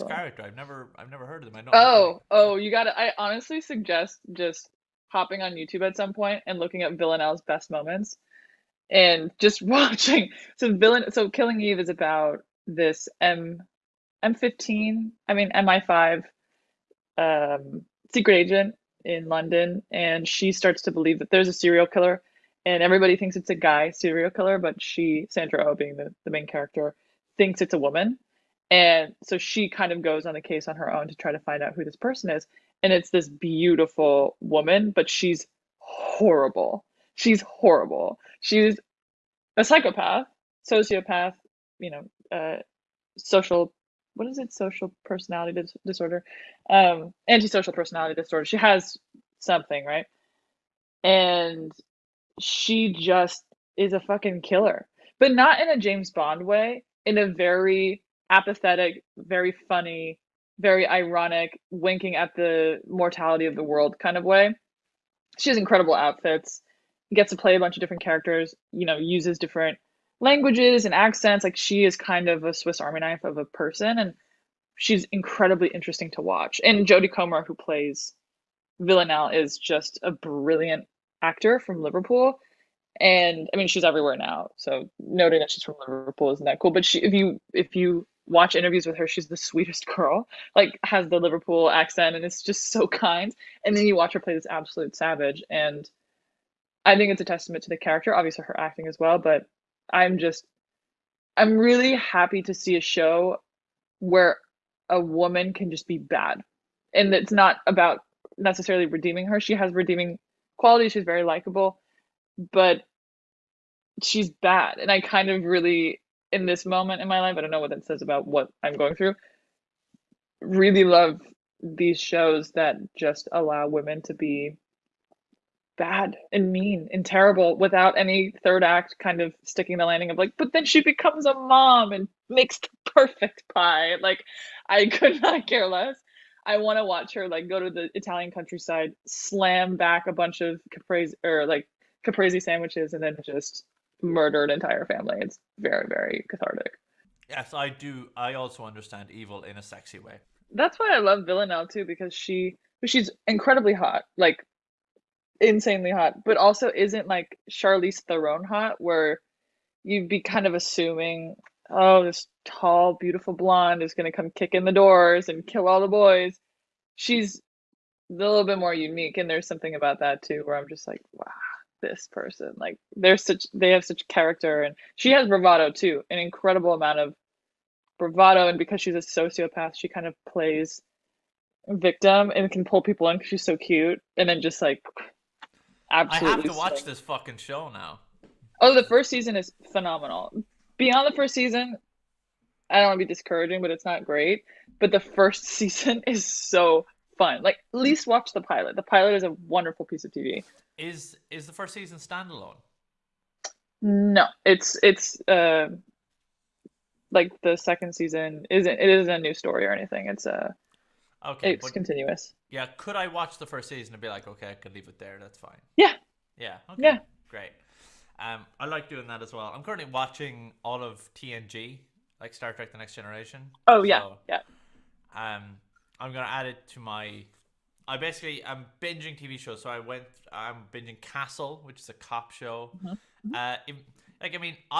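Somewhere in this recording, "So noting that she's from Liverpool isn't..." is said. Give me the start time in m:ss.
1:24.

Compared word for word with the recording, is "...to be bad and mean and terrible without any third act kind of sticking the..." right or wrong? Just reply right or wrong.
right.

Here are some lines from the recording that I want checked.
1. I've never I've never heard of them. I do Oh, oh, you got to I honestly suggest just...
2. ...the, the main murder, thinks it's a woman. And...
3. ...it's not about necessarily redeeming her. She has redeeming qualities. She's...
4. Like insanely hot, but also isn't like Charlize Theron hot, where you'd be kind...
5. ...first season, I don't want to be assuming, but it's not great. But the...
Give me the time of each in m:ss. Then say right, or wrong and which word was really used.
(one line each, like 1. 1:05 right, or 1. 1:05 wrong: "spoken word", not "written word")
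1. 0:00 right
2. 0:25 wrong: "character", not "murder"
3. 1:47 right
4. 2:34 right
5. 3:11 wrong: "discouraging", not "assuming".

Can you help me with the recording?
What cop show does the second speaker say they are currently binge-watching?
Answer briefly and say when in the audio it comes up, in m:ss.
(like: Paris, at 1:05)
Castle, at 3:51.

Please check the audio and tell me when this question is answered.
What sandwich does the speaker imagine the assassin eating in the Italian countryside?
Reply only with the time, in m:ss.
2:22.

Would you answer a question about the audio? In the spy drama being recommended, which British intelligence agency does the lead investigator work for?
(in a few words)
MI5.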